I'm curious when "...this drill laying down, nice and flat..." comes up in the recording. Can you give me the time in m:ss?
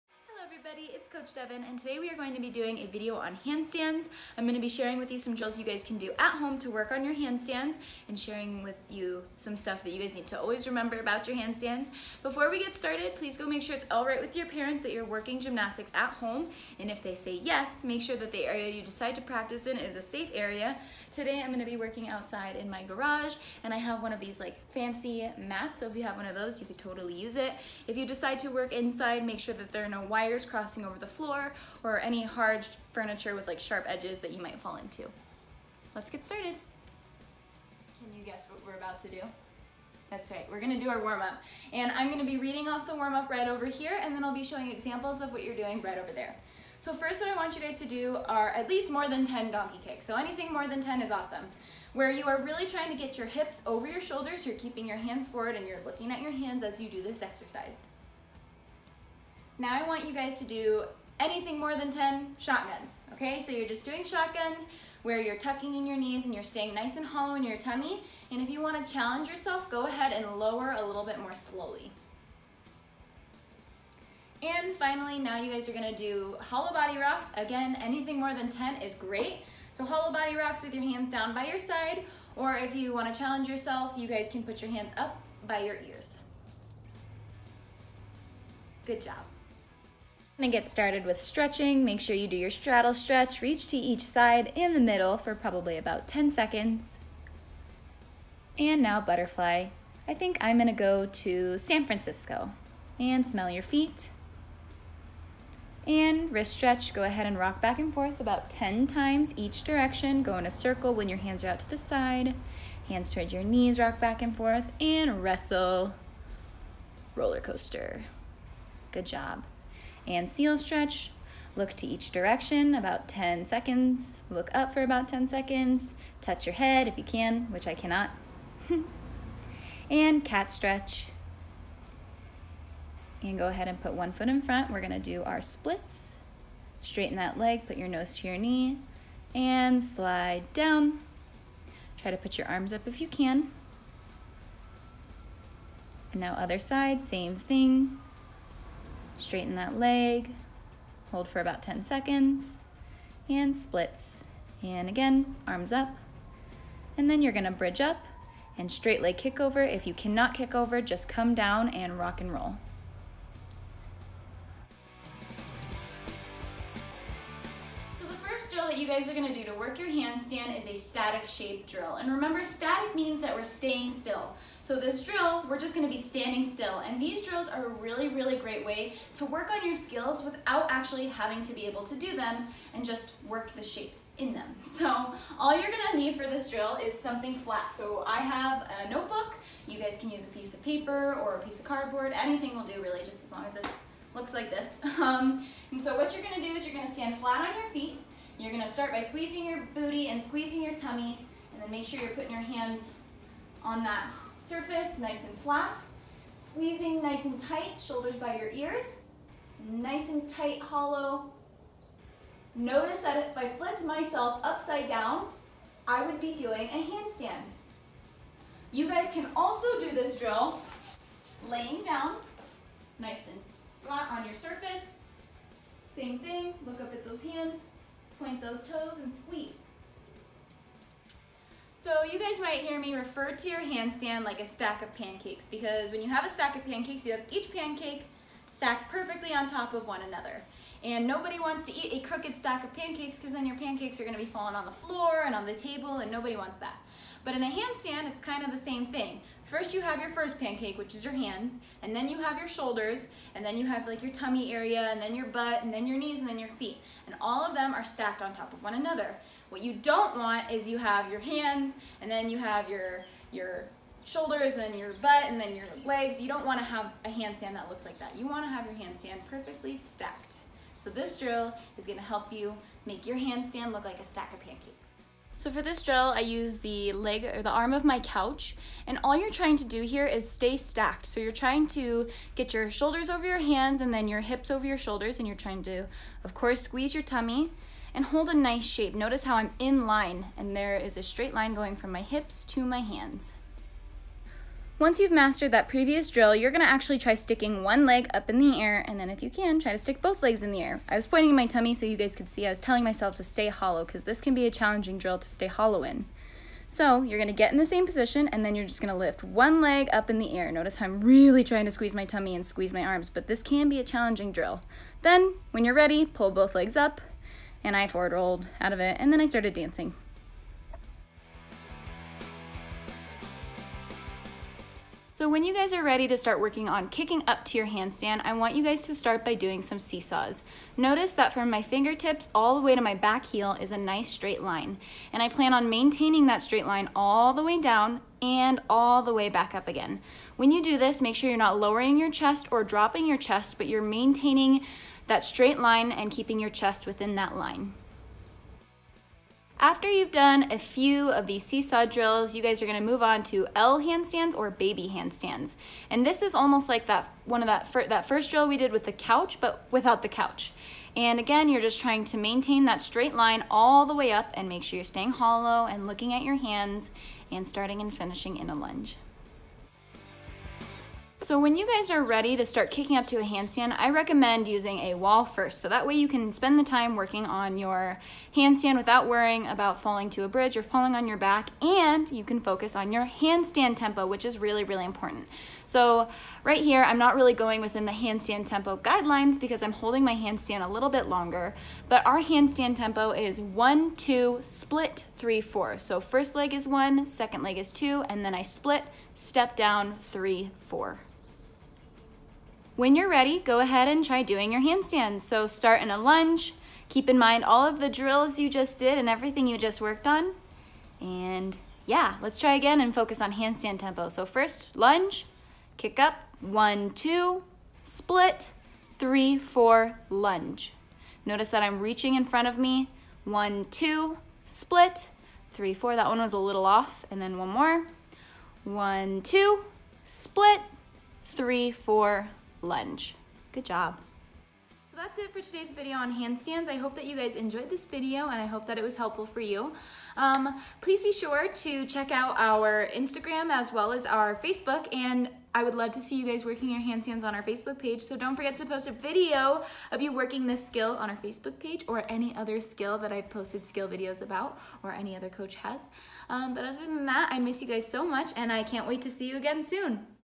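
3:39.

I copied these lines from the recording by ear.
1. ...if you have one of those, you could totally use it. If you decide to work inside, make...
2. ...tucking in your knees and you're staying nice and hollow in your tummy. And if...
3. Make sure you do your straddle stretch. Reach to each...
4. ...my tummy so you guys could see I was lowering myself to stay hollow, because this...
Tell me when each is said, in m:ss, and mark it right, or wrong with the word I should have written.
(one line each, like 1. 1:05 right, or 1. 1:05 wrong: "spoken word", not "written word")
1. 0:25 right
2. 1:05 right
3. 1:31 right
4. 5:01 wrong: "telling", not "lowering".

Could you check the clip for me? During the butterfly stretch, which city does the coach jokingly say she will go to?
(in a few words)
San Francisco.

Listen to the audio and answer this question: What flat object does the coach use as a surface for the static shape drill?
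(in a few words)
Notebook.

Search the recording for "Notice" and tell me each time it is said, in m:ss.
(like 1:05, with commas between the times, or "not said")
3:32, 4:48, 5:10, 5:30, 7:01.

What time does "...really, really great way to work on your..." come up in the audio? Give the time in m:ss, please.
2:57.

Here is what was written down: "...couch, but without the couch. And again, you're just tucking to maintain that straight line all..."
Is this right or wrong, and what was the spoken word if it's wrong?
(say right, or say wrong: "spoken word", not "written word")
wrong: "trying", not "tucking".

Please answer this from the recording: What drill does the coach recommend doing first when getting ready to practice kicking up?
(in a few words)
Seesaws.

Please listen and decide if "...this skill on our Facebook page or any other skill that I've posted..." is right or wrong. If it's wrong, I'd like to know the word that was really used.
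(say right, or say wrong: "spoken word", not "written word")
right.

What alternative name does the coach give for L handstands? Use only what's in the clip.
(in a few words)
Baby handstands.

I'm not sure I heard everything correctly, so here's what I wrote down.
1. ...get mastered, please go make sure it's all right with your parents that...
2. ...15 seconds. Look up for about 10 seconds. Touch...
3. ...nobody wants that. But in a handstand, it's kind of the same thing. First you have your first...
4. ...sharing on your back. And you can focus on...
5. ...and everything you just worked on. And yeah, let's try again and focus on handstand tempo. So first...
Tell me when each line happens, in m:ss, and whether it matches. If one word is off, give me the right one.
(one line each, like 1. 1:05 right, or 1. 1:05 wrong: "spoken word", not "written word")
1. 0:12 wrong: "started", not "mastered"
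2. 2:03 wrong: "10", not "15"
3. 4:06 right
4. 6:20 wrong: "falling", not "sharing"
5. 6:48 right.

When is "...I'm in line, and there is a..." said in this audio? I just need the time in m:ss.
4:49.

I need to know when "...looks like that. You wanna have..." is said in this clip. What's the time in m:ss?
4:27.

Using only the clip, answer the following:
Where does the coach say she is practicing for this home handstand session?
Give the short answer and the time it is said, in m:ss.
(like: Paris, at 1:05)
Garage, at 0:22.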